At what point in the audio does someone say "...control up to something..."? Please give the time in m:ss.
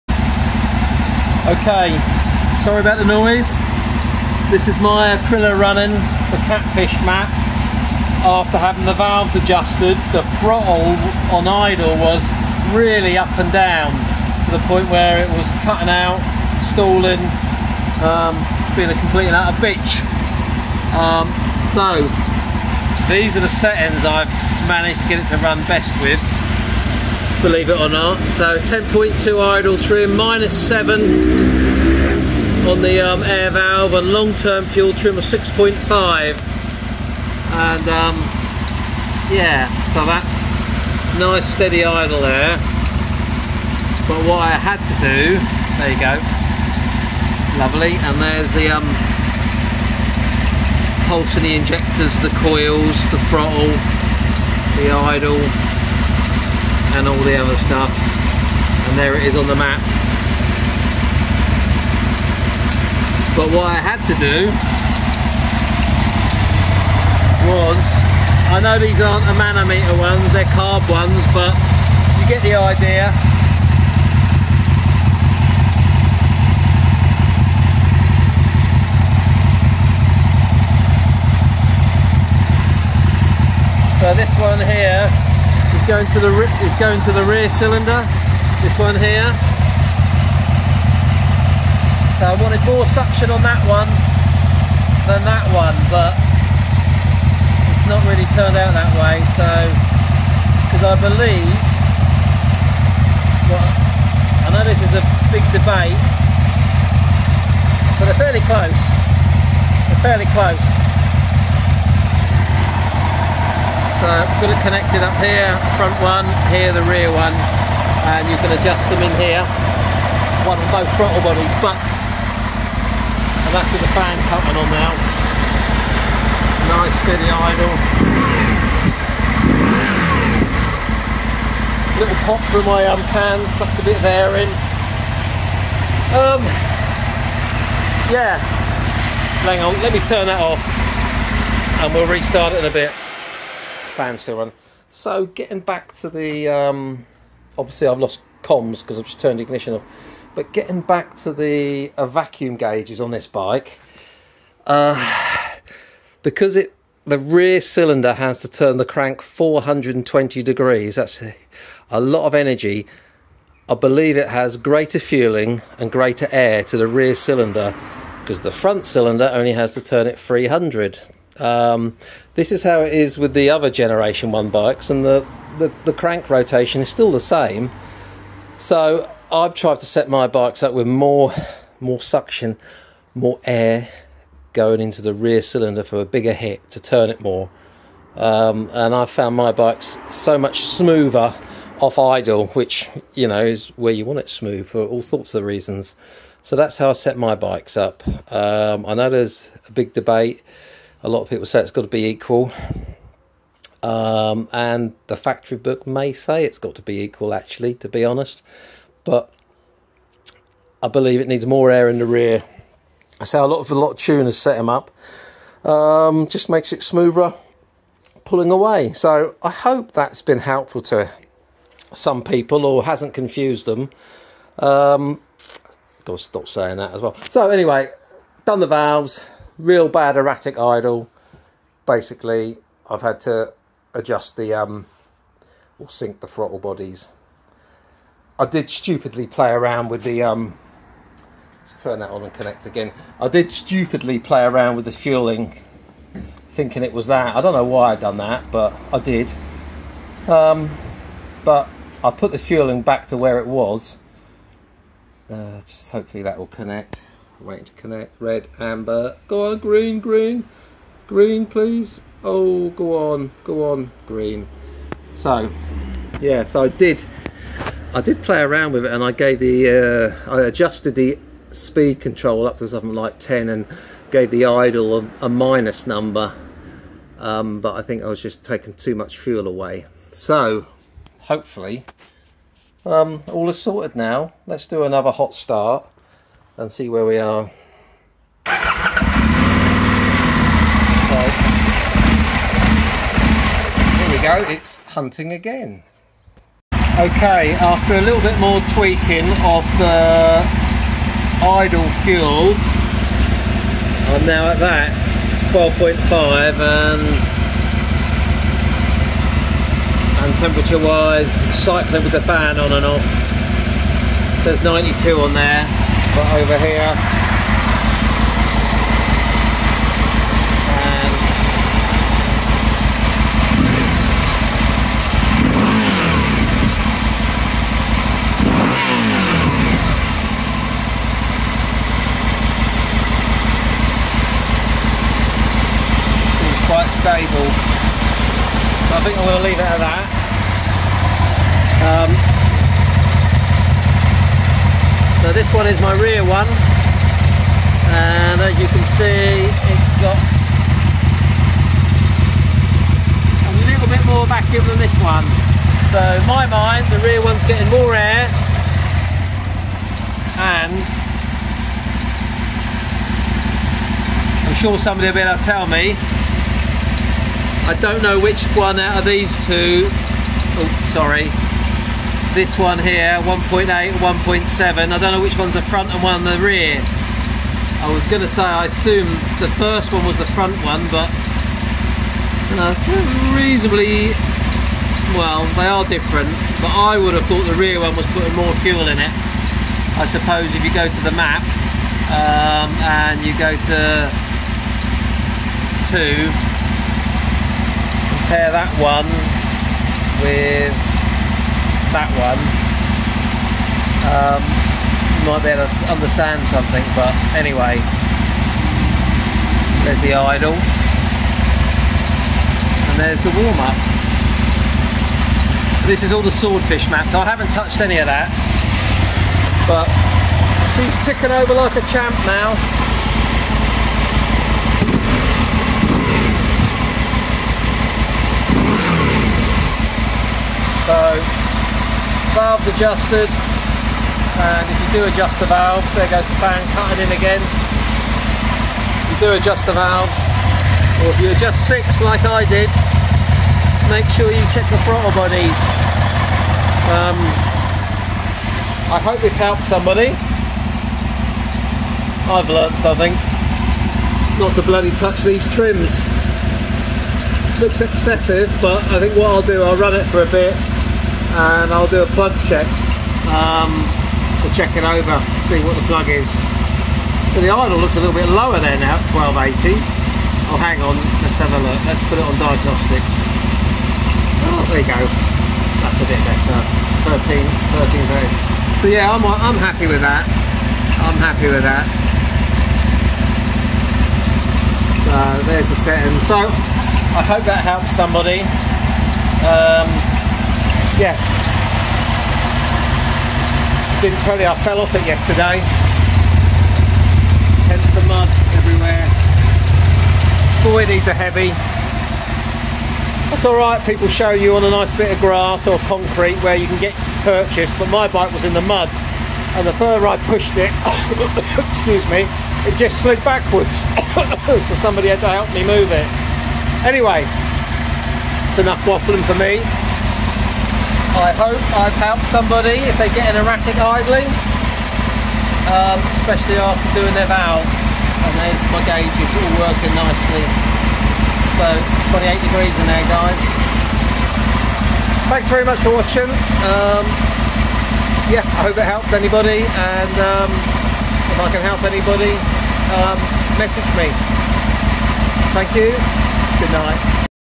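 4:31.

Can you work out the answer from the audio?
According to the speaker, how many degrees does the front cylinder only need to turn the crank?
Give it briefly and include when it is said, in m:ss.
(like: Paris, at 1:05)
300, at 2:50.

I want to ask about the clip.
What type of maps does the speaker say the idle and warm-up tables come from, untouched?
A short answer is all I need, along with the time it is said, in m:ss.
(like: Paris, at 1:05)
swordfish maps, at 6:56.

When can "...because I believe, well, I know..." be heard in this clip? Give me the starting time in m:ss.
1:40.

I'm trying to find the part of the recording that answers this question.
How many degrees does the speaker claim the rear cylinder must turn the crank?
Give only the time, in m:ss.
2:39.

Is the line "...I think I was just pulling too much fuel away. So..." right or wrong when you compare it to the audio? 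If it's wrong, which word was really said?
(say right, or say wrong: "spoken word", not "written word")
wrong: "taking", not "pulling".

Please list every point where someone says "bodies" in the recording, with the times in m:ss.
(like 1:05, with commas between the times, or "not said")
2:01, 3:56, 7:25.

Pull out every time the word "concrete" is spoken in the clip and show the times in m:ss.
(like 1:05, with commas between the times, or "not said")
8:25.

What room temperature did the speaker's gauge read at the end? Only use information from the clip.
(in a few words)
28 degrees.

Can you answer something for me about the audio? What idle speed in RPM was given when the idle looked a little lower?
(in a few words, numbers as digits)
1280.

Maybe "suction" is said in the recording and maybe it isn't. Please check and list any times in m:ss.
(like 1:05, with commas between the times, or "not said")
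1:32, 3:01.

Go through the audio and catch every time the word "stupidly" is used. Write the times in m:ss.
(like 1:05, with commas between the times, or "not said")
3:58, 4:03.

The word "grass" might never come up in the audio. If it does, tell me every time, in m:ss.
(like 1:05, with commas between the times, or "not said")
8:25.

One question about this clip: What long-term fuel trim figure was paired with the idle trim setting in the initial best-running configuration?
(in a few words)
6.5.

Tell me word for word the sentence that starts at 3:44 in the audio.
Um, gotta stop saying that as well.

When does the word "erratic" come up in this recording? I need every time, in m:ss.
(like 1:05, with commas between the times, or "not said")
3:50, 8:43.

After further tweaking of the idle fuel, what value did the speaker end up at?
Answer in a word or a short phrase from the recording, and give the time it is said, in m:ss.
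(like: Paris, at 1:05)
12.5, at 5:05.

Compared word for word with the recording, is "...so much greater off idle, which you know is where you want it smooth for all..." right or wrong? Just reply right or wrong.
wrong.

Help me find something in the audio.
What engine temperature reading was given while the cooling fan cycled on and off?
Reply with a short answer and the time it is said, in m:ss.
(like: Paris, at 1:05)
92, at 5:14.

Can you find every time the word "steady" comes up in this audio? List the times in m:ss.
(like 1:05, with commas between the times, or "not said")
0:41, 2:07.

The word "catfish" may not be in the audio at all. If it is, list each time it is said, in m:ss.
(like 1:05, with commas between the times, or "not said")
0:06.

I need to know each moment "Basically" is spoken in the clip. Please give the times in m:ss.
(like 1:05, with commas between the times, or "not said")
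3:51.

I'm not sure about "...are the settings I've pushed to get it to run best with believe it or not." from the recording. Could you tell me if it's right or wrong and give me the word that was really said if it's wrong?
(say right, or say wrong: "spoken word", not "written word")
wrong: "managed", not "pushed".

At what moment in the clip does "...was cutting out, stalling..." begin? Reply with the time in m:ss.
0:15.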